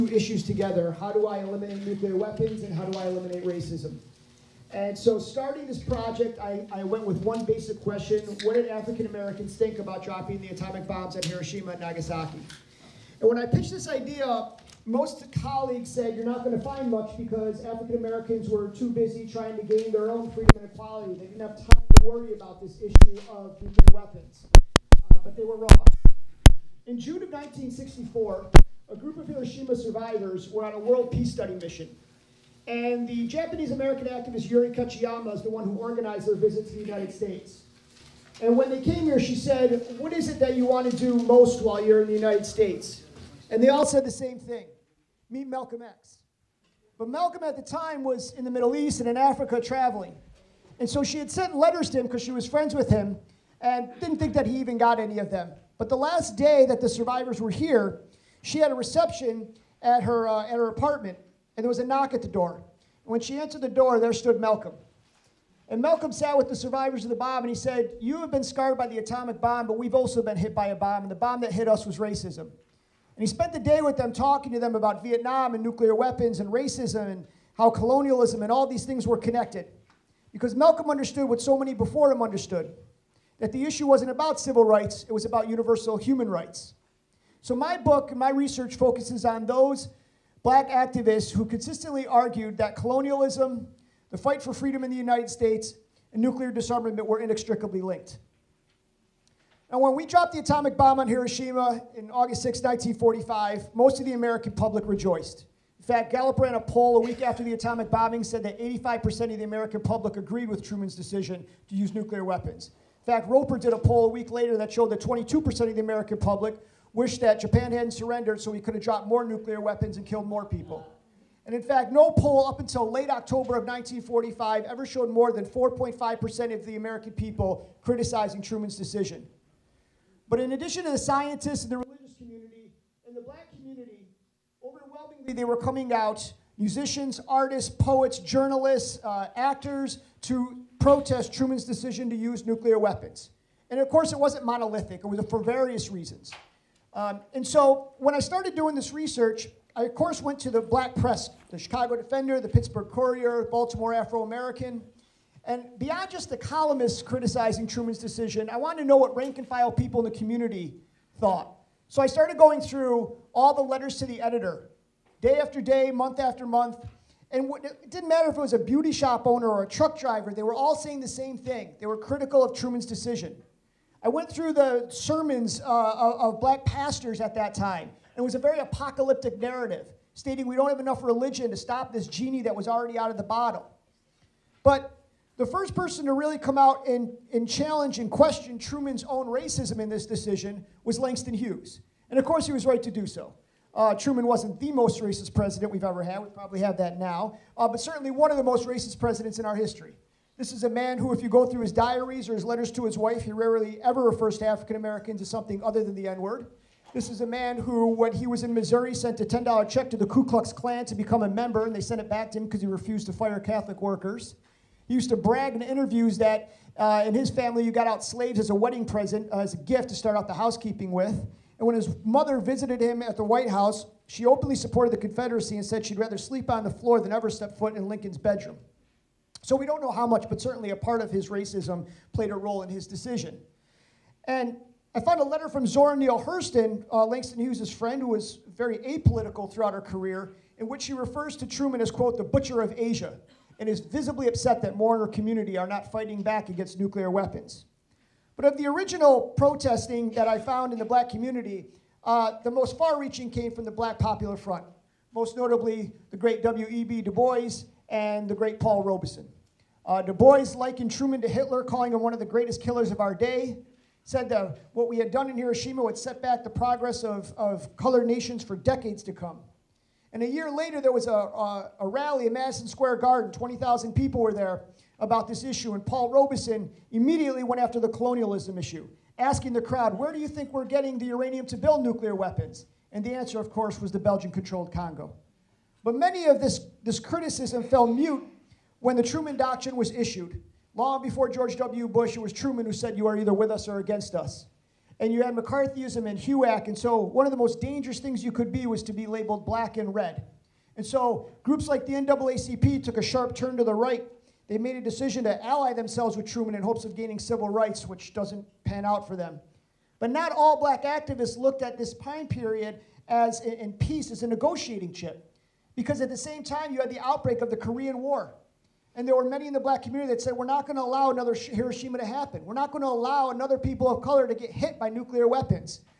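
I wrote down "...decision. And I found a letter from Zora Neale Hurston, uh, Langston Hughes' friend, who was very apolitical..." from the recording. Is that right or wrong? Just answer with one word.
right.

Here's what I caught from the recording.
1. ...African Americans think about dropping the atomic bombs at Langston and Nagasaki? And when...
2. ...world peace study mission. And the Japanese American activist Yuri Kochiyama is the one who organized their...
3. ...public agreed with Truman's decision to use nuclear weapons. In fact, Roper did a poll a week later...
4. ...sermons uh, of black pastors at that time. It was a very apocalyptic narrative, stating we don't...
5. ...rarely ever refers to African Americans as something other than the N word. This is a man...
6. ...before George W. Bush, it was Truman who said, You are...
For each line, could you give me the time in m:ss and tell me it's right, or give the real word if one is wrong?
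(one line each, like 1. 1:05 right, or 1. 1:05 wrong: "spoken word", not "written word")
1. 0:08 wrong: "Hiroshima", not "Langston"
2. 0:30 right
3. 1:49 right
4. 2:54 right
5. 3:23 right
6. 4:51 right.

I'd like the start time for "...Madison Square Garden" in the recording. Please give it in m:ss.
4:32.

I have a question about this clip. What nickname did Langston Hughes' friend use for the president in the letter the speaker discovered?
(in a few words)
the butcher of Asia.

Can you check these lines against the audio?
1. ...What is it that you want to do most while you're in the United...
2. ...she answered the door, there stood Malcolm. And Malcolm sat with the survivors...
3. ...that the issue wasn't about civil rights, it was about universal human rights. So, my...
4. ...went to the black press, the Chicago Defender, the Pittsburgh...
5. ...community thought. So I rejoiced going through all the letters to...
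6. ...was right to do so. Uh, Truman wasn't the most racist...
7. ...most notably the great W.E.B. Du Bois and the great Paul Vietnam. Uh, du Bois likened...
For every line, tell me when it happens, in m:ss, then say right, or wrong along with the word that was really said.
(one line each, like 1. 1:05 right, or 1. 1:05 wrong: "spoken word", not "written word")
1. 0:39 right
2. 1:03 right
3. 1:23 right
4. 2:30 right
5. 2:40 wrong: "started", not "rejoiced"
6. 3:12 right
7. 4:15 wrong: "Robeson", not "Vietnam".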